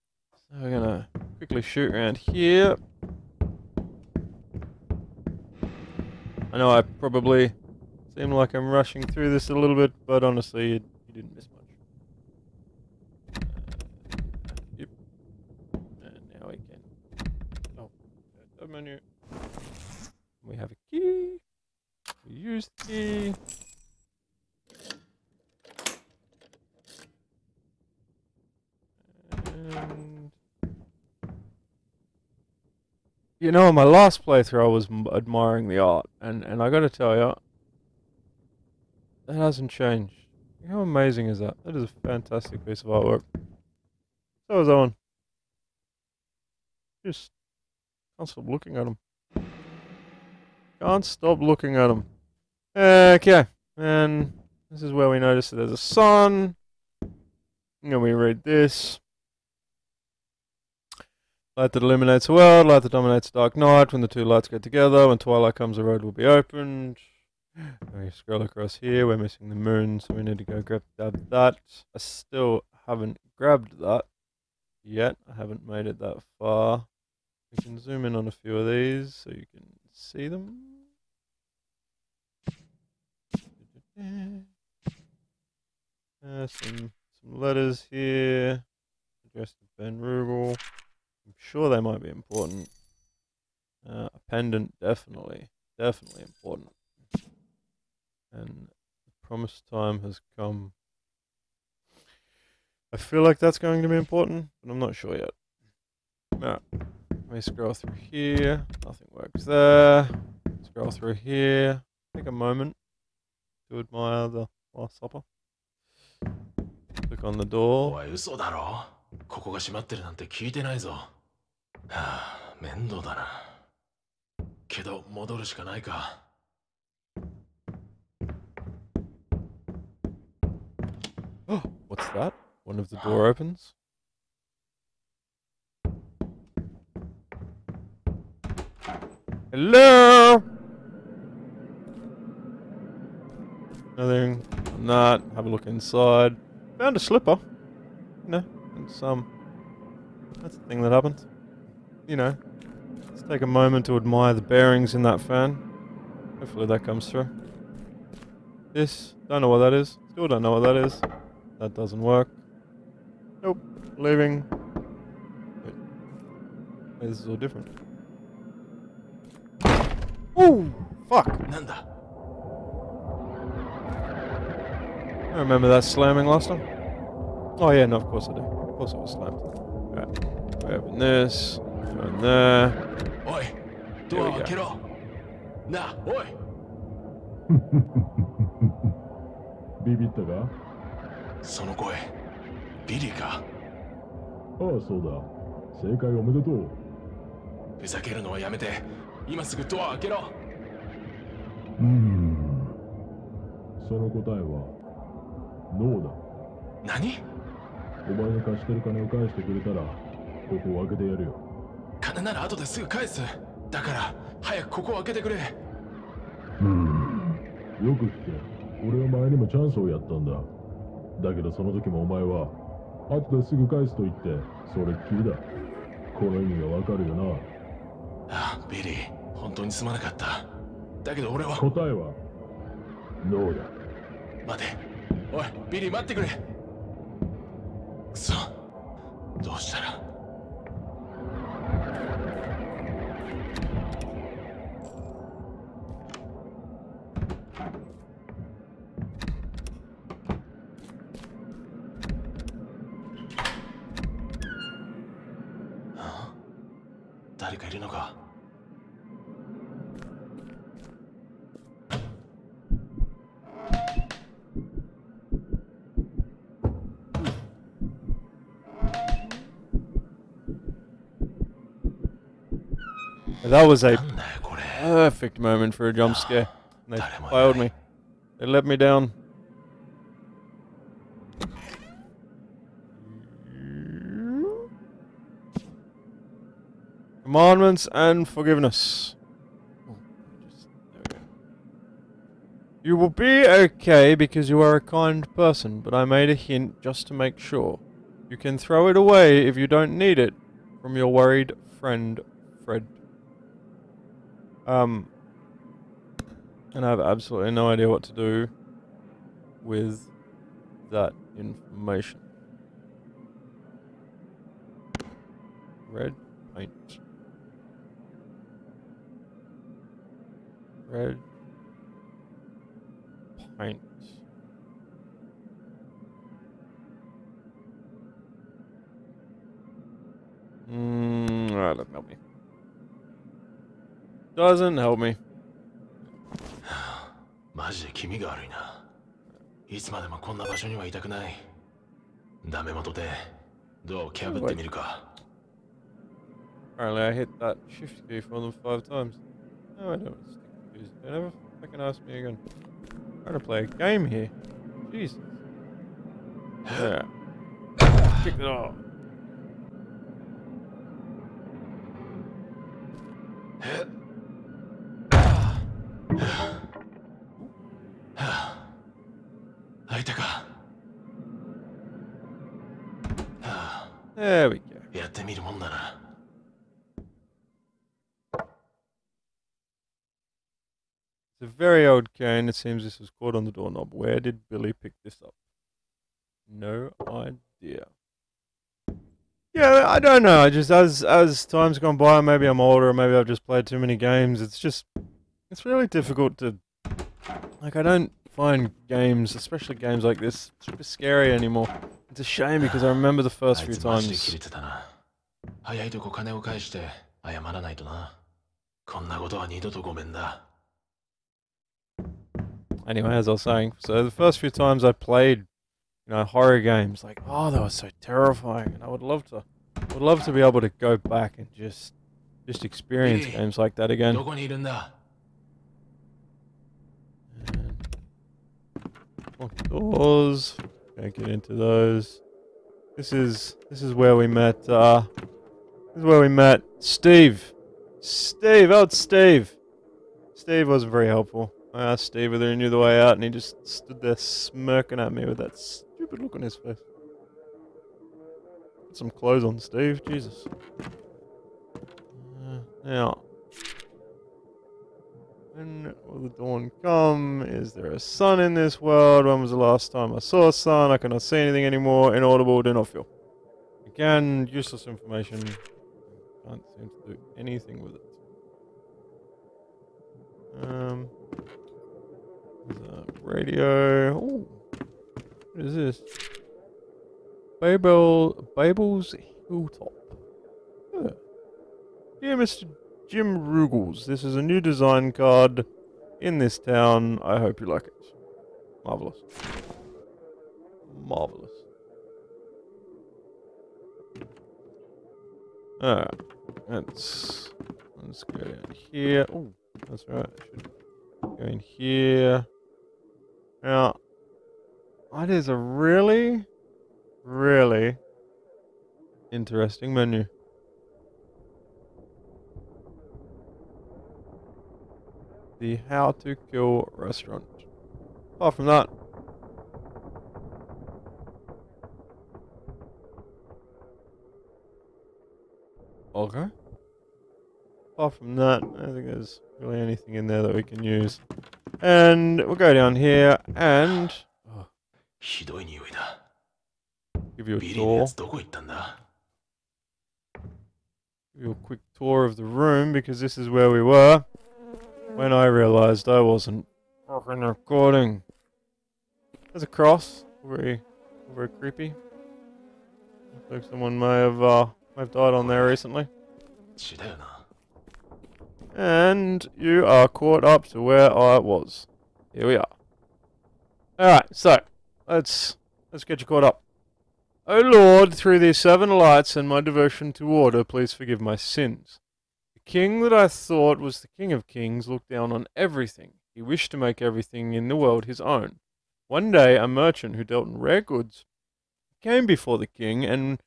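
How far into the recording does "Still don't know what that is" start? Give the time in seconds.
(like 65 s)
160 s.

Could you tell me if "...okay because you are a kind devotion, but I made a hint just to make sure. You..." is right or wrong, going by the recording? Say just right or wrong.
wrong.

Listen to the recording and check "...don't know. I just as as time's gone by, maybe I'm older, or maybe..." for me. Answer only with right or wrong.
right.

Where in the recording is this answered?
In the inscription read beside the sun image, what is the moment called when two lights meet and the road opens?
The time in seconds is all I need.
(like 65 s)
65 s.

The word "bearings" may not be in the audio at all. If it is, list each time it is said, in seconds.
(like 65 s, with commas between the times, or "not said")
154 s.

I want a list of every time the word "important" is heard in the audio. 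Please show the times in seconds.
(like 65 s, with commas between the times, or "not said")
92 s, 96 s, 103 s.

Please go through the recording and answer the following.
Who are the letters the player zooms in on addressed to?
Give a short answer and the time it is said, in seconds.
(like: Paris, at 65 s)
Ben Rubel, at 89 s.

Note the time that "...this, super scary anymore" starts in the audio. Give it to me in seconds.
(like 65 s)
400 s.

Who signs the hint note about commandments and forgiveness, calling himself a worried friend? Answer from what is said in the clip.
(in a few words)
Fred.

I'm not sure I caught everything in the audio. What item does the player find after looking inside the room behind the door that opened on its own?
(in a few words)
A slipper.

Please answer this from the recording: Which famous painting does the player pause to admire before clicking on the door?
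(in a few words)
The Last Supper.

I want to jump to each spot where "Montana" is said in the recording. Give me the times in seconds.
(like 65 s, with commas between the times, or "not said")
not said.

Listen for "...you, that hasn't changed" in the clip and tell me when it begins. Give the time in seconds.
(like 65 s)
37 s.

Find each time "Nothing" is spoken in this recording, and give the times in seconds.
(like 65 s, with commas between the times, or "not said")
108 s, 143 s.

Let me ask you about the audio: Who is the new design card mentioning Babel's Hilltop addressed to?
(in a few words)
Jim Ruggles.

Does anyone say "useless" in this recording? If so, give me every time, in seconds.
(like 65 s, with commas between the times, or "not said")
464 s.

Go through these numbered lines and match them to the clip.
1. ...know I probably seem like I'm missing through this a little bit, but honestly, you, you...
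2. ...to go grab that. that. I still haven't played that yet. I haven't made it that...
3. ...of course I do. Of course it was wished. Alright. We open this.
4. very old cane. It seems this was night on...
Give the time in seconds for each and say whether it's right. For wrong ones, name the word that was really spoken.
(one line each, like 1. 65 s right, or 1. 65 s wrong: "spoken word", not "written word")
1. 6 s wrong: "rushing", not "missing"
2. 70 s wrong: "grabbed", not "played"
3. 177 s wrong: "slammed", not "wished"
4. 381 s wrong: "caught", not "night".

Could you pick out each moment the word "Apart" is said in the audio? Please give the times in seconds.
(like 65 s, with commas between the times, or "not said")
518 s, 527 s.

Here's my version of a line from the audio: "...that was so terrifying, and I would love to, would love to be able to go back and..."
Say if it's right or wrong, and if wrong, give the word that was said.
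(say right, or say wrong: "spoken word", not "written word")
right.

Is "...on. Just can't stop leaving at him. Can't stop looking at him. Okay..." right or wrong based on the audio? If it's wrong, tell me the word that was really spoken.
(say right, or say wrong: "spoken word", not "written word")
wrong: "looking", not "leaving".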